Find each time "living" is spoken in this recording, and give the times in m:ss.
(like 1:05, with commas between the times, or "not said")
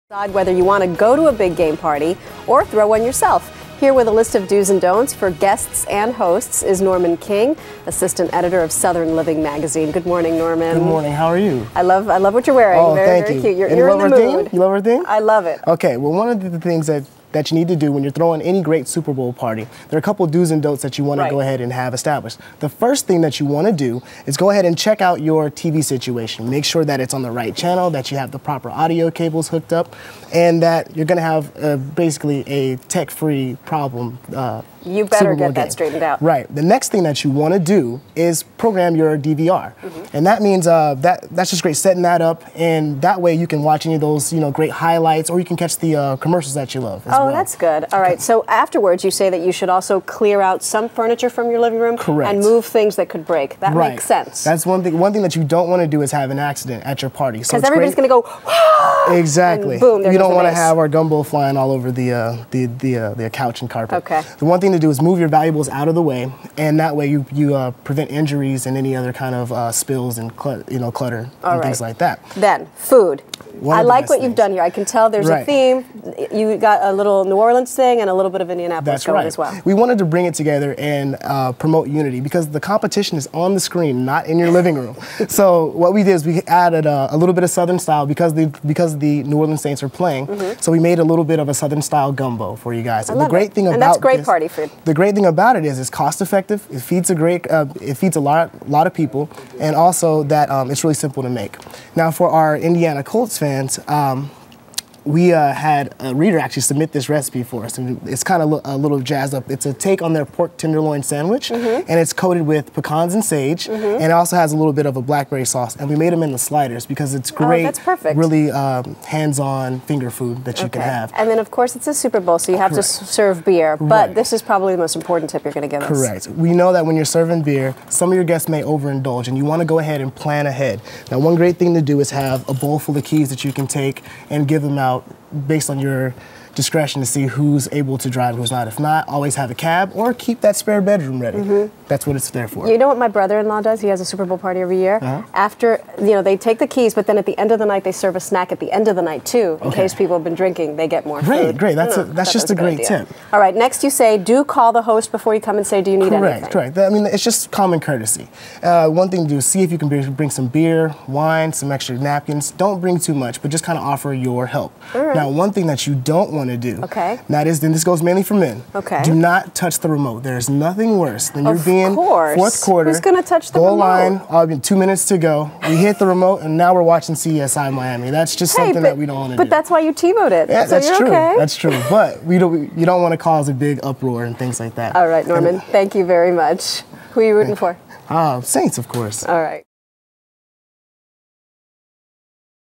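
0:09, 0:51, 1:24.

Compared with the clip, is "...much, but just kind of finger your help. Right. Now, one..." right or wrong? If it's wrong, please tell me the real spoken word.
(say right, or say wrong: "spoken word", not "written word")
wrong: "offer", not "finger".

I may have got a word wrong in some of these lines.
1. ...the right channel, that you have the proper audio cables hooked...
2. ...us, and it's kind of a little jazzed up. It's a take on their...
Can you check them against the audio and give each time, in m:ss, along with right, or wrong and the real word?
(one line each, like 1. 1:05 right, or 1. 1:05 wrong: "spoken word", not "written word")
1. 0:27 right
2. 1:47 right.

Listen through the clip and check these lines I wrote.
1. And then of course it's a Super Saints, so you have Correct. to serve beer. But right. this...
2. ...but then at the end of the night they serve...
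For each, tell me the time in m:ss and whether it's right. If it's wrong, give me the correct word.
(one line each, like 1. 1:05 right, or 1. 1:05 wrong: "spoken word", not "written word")
1. 2:01 wrong: "Bowl", not "Saints"
2. 2:26 right.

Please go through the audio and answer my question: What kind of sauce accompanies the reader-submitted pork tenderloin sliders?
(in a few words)
Blackberry sauce.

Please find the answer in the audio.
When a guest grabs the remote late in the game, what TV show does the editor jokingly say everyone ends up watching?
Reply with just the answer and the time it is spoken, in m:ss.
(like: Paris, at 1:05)
CSI Miami, at 2:57.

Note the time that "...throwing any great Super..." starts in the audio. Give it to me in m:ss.
0:18.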